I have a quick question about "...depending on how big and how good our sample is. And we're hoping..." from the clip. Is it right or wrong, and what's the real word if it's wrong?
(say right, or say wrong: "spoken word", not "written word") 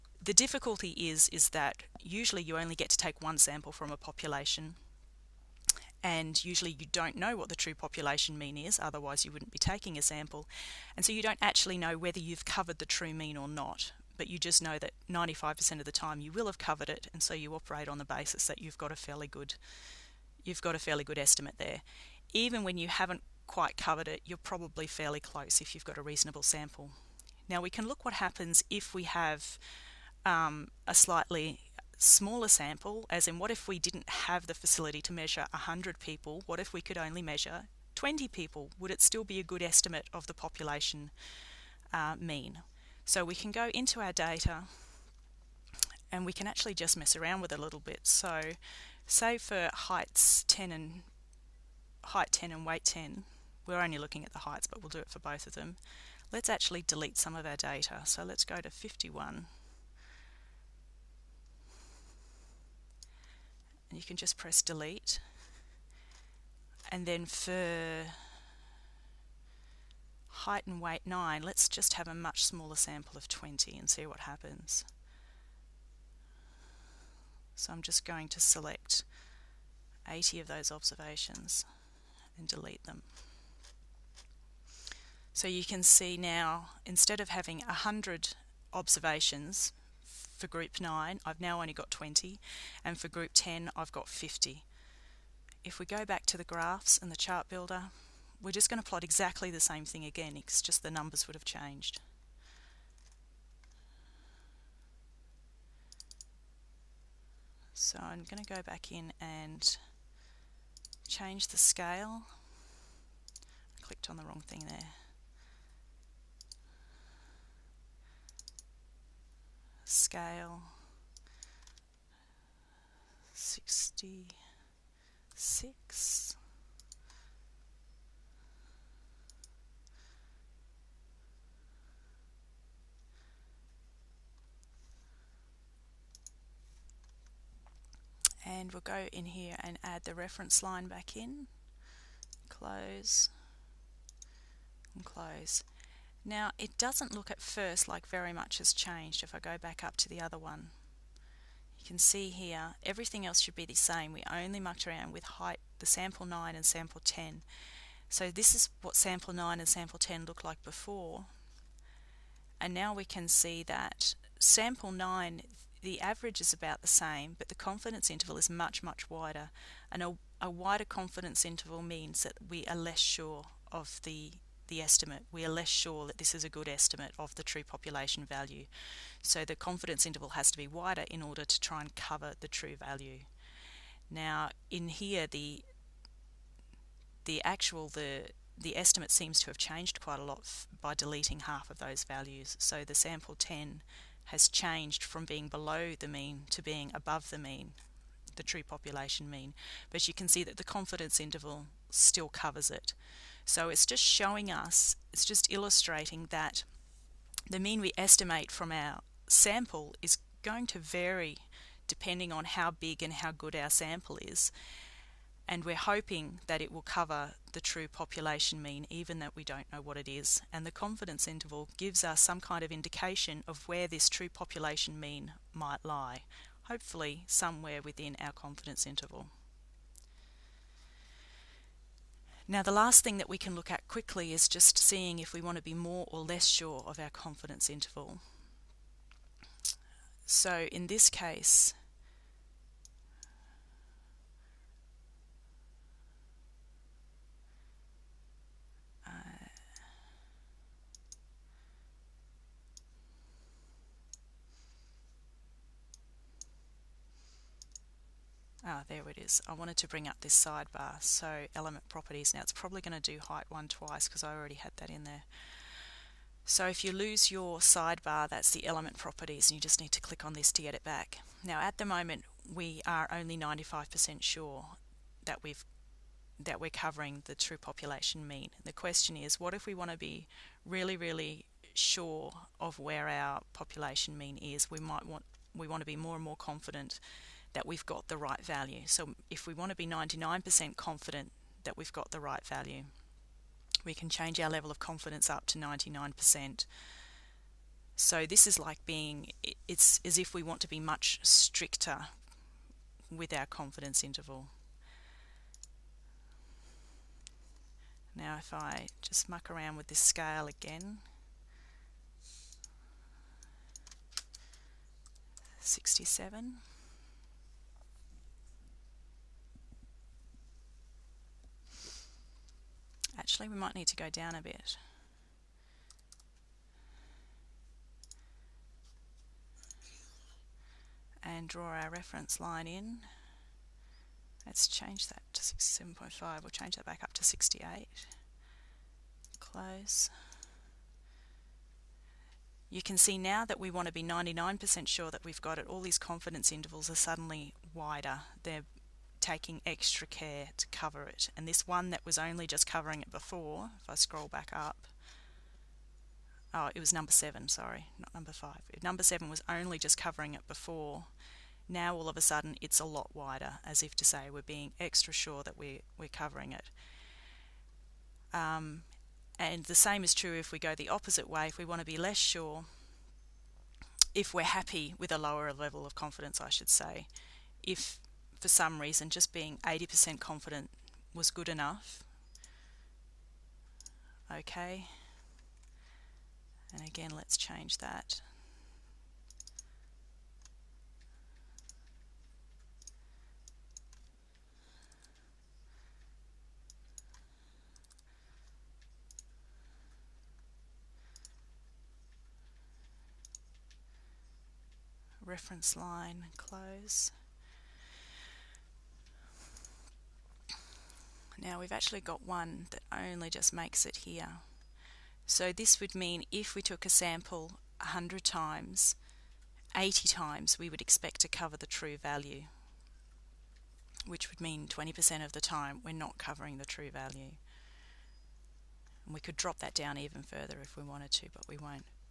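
right.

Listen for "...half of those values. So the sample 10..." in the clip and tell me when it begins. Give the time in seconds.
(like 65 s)
191 s.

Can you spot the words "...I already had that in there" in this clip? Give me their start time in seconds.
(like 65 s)
264 s.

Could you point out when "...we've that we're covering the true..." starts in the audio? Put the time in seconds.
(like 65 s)
275 s.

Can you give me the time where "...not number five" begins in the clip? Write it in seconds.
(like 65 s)
357 s.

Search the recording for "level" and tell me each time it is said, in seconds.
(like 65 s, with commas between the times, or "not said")
294 s, 375 s.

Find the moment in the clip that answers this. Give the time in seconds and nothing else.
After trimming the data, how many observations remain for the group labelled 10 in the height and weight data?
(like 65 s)
94 s.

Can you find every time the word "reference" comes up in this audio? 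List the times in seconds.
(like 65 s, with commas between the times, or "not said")
140 s, 331 s, 405 s.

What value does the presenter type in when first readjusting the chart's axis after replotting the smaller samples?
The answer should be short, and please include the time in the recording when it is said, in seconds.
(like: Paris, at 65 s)
66, at 123 s.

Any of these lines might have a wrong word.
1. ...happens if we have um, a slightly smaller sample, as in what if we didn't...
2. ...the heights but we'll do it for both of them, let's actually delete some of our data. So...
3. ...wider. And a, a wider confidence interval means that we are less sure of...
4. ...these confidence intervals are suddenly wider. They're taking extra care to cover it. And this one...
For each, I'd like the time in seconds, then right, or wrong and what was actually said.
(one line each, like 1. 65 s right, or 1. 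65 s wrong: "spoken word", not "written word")
1. 28 s right
2. 54 s right
3. 169 s right
4. 345 s right.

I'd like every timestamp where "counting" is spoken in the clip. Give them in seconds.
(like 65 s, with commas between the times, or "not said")
not said.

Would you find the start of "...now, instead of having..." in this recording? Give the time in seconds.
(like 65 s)
86 s.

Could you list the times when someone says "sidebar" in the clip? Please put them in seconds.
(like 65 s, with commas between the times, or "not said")
260 s, 267 s.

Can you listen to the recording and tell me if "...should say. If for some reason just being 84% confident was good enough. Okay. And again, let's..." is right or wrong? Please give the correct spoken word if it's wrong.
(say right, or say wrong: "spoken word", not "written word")
wrong: "80", not "84".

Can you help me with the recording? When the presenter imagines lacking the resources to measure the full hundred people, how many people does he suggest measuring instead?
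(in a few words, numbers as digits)
20.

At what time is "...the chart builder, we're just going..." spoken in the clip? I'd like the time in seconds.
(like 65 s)
97 s.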